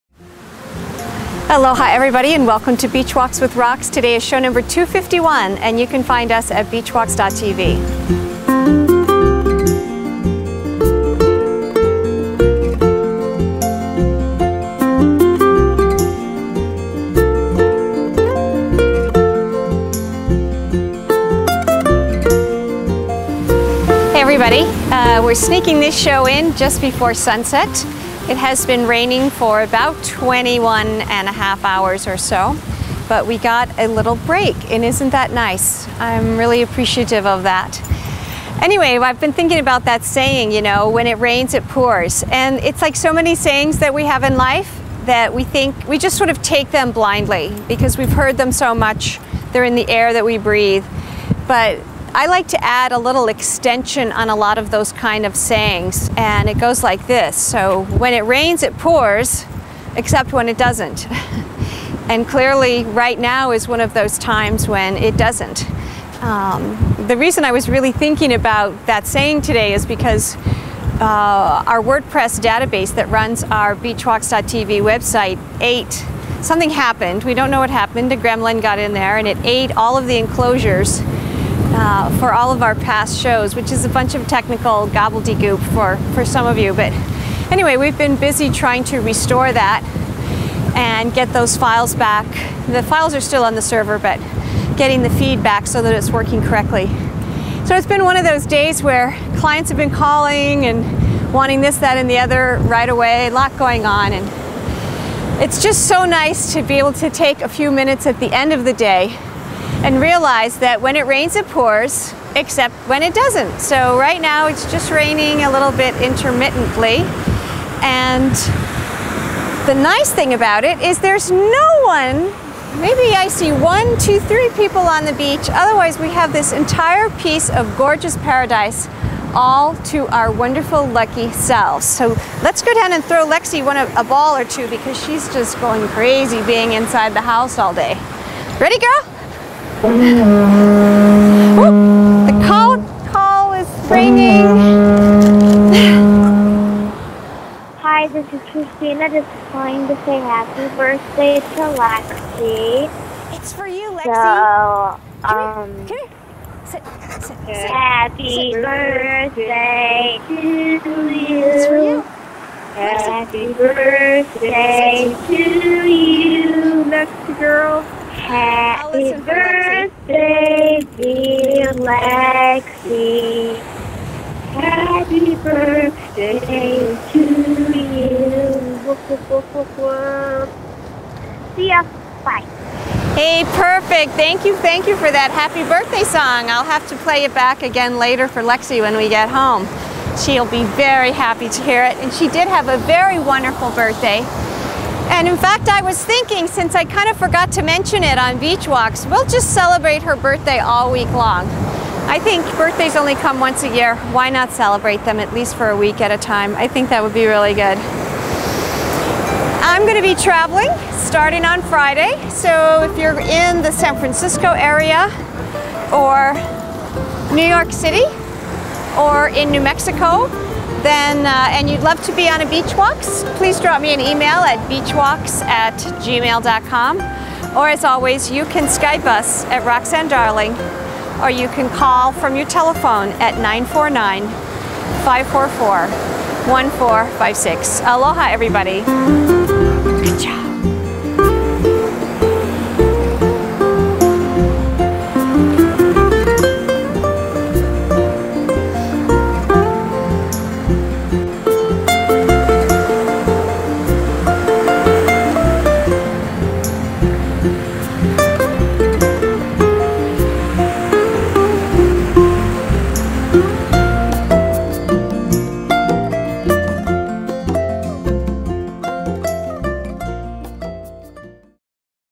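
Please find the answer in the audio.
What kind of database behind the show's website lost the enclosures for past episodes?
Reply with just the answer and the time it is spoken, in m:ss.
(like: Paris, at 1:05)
WordPress, at 1:11.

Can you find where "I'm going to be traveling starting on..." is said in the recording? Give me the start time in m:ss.
3:29.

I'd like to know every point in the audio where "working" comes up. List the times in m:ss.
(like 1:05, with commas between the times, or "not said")
1:36.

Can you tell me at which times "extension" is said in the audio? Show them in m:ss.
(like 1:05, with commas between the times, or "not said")
0:53.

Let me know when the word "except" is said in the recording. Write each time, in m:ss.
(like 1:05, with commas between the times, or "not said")
0:59, 1:52.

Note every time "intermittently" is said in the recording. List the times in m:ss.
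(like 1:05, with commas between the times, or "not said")
1:56.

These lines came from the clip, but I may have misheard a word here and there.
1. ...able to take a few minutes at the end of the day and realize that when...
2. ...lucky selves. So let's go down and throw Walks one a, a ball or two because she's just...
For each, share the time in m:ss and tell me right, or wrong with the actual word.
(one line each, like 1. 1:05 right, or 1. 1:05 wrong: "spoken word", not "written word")
1. 1:46 right
2. 2:10 wrong: "Lexi", not "Walks".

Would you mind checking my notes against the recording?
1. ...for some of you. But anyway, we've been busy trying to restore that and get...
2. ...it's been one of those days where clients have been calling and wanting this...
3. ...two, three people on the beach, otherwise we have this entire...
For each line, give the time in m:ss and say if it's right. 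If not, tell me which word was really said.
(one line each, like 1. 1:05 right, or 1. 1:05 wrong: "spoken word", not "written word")
1. 1:26 right
2. 1:37 right
3. 2:03 right.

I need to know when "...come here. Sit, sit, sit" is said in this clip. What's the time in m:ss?
2:35.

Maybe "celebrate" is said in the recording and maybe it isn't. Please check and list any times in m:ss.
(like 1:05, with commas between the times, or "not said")
3:19, 3:24.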